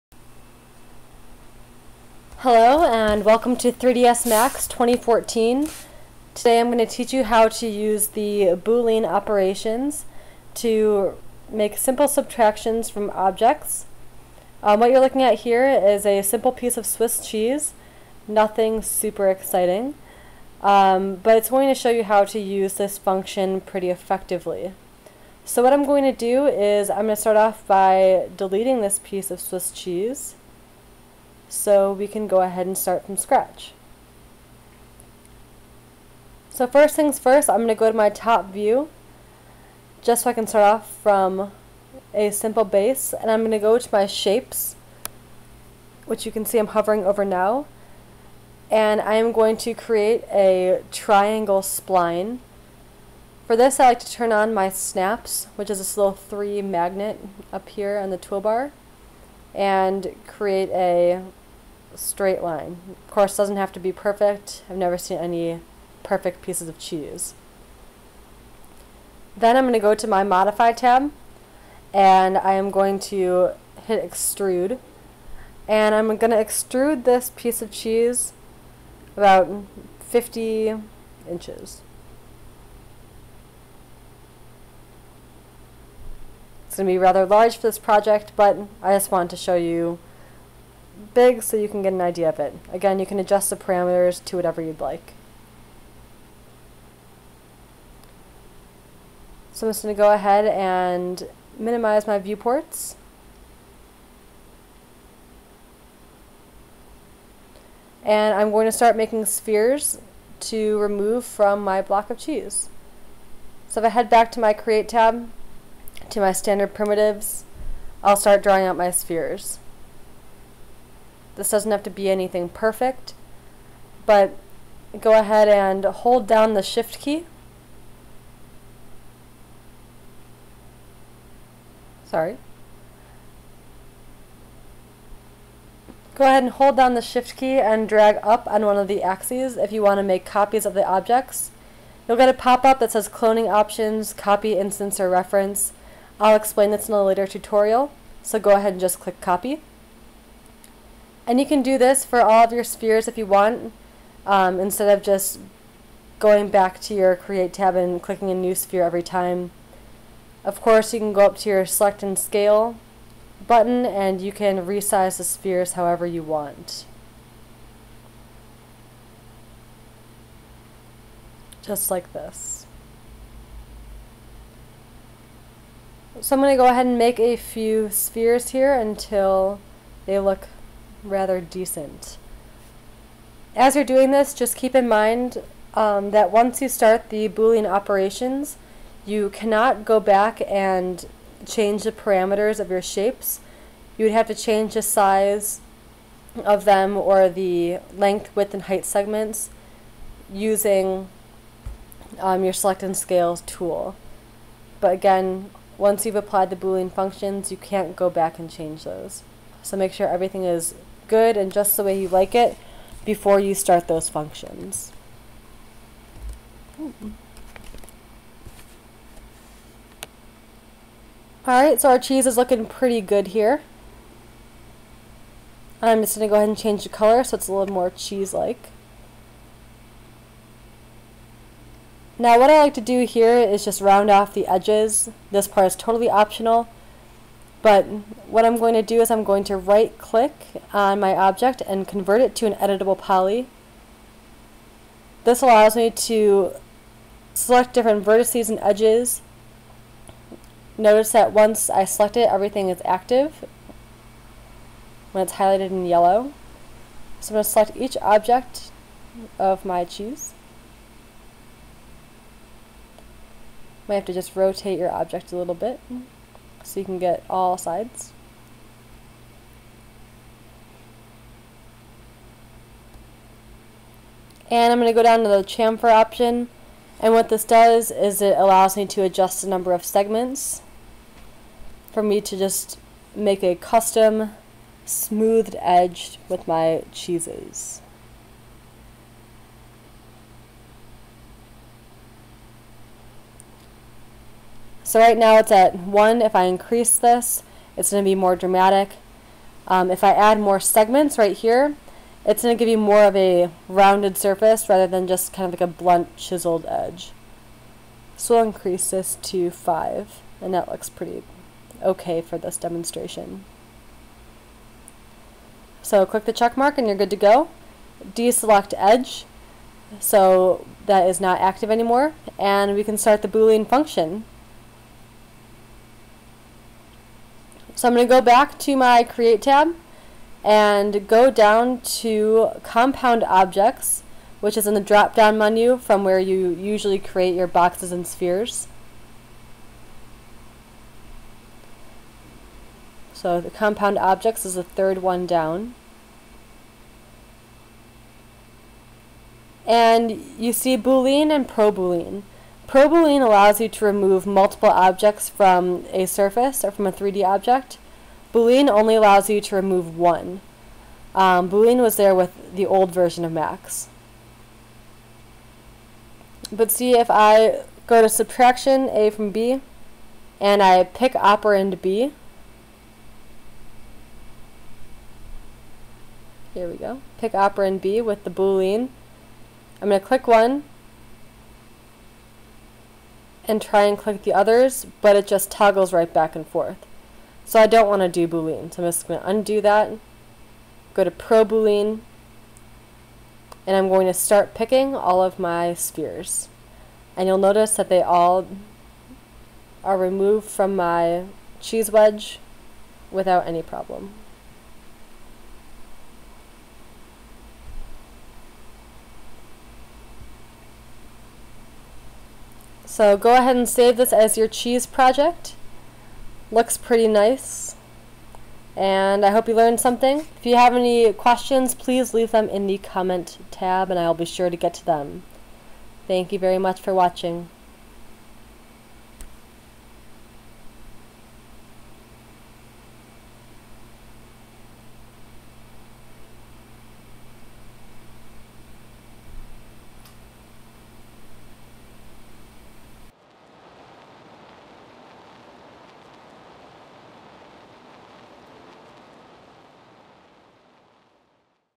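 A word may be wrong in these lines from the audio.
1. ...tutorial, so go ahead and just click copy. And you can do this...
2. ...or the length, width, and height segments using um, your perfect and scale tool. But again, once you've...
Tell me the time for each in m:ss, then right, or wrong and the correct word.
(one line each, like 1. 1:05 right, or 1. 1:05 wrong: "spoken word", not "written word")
1. 2:27 right
2. 3:16 wrong: "select", not "perfect".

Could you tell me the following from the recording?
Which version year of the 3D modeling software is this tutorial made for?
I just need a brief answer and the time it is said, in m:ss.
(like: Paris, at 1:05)
2014, at 0:04.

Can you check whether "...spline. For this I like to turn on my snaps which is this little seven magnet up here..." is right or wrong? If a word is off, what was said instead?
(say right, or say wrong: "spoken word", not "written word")
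wrong: "three", not "seven".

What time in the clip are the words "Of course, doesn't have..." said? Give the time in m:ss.
1:02.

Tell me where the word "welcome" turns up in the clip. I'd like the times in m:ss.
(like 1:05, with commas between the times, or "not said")
0:03.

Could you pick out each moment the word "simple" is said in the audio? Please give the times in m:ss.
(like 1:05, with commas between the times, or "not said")
0:11, 0:16, 0:42.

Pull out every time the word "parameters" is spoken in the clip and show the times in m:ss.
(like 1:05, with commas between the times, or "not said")
1:33, 3:11.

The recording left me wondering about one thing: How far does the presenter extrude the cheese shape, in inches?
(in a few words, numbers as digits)
50 inches.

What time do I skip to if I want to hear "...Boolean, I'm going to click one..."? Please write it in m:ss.
6:18.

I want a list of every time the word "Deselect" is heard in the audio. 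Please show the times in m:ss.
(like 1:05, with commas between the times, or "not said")
5:18.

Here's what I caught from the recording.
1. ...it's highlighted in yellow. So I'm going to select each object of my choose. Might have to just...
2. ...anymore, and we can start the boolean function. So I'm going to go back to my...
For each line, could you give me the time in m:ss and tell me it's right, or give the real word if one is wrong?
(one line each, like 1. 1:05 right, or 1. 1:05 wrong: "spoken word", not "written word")
1. 4:15 right
2. 5:21 right.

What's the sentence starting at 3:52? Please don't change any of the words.
Now what I like to do here is just round off the edges.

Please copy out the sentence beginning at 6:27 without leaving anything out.
So I don't want to do Boolean.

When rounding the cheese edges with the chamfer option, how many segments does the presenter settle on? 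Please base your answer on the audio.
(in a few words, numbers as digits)
5.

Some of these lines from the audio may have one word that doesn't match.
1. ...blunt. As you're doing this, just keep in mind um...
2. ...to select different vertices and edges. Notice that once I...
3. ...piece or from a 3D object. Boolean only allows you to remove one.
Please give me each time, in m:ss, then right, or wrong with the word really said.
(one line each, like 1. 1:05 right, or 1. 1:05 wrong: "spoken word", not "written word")
1. 3:01 wrong: "decent", not "blunt"
2. 4:05 right
3. 5:56 wrong: "surface", not "piece".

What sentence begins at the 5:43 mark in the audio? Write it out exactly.
So the Compound Objects is the third one down.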